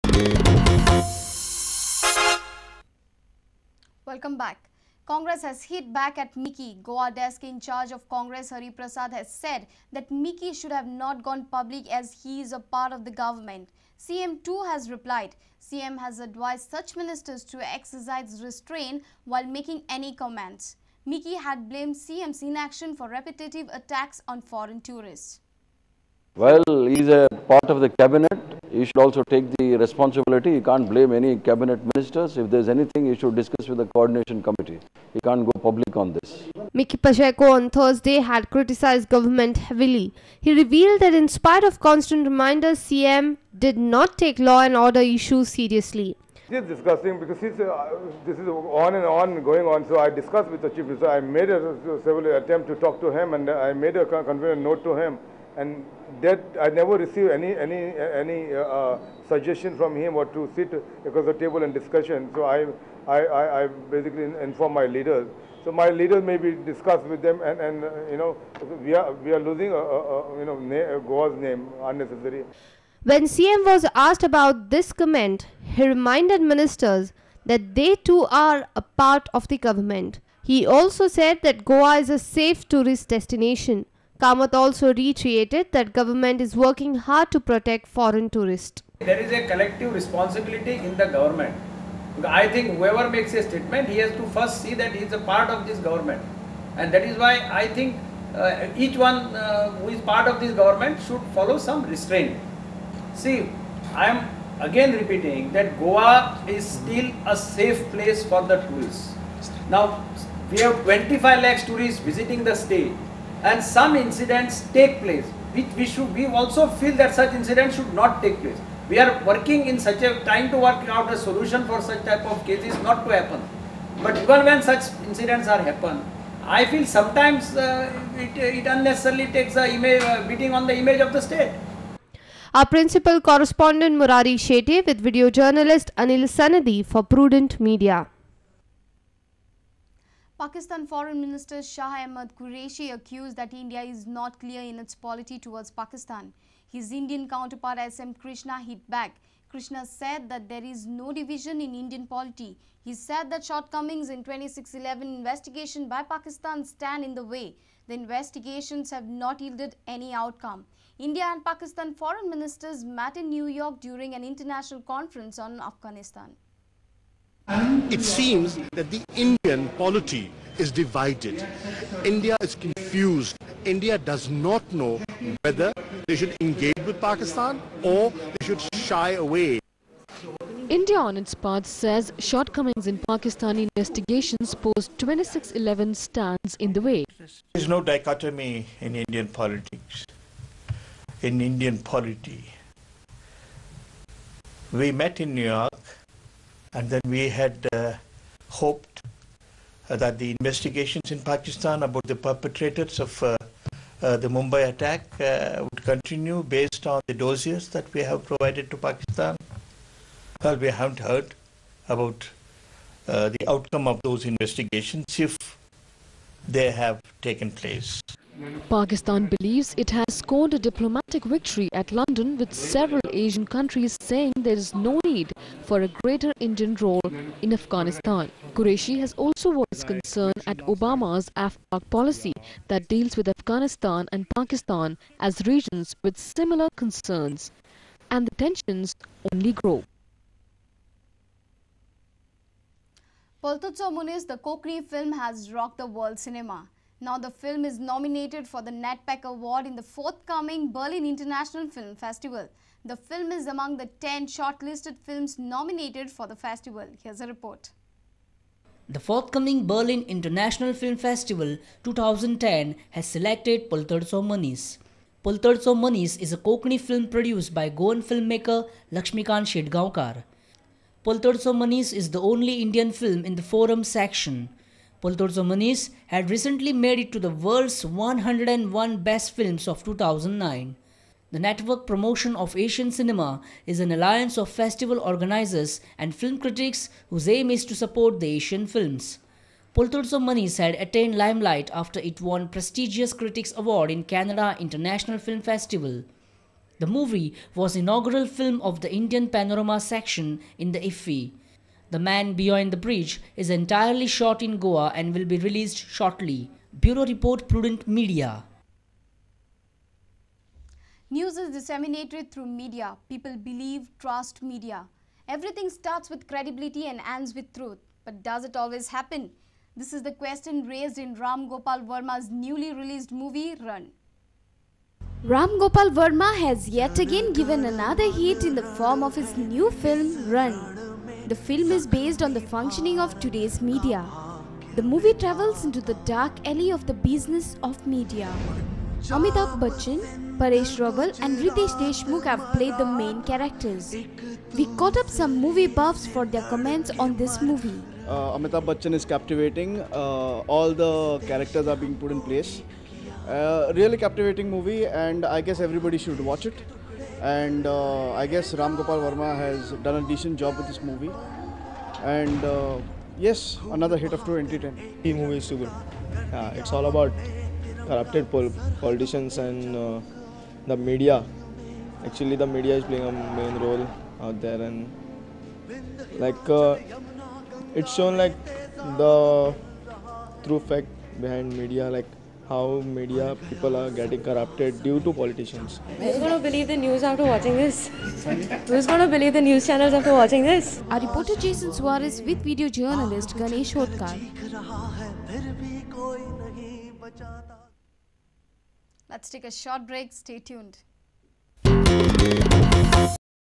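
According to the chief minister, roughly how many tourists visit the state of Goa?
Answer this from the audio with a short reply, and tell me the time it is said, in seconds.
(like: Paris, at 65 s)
25 lakhs, at 110 s.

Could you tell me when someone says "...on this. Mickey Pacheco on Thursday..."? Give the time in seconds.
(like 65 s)
35 s.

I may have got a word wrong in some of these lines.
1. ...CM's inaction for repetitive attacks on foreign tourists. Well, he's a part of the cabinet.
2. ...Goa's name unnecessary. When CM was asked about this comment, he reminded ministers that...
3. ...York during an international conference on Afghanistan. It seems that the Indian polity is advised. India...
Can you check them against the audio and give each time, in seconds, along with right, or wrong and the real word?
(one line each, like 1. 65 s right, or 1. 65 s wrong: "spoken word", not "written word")
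1. 21 s right
2. 70 s right
3. 163 s wrong: "divided", not "advised".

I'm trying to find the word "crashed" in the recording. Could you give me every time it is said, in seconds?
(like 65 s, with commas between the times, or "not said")
not said.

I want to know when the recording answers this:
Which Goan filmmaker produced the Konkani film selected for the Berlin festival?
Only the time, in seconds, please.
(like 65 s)
268 s.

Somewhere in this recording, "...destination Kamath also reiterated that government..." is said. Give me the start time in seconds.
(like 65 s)
83 s.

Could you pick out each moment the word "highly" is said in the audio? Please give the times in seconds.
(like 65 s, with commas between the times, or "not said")
not said.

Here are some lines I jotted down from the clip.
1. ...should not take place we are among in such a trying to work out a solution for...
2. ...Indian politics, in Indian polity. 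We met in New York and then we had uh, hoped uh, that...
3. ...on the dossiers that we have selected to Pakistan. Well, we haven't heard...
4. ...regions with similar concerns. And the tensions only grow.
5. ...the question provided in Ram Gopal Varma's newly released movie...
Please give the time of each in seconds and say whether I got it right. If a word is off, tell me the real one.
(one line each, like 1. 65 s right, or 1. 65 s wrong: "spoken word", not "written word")
1. 117 s wrong: "working", not "among"
2. 188 s right
3. 206 s wrong: "provided", not "selected"
4. 235 s right
5. 320 s wrong: "raised", not "provided".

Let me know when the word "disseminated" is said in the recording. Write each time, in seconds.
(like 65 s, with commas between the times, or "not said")
311 s.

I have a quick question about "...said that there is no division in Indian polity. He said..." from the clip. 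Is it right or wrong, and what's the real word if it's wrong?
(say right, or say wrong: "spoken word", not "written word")
right.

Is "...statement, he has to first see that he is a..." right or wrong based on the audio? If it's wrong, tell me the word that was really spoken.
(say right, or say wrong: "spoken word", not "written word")
right.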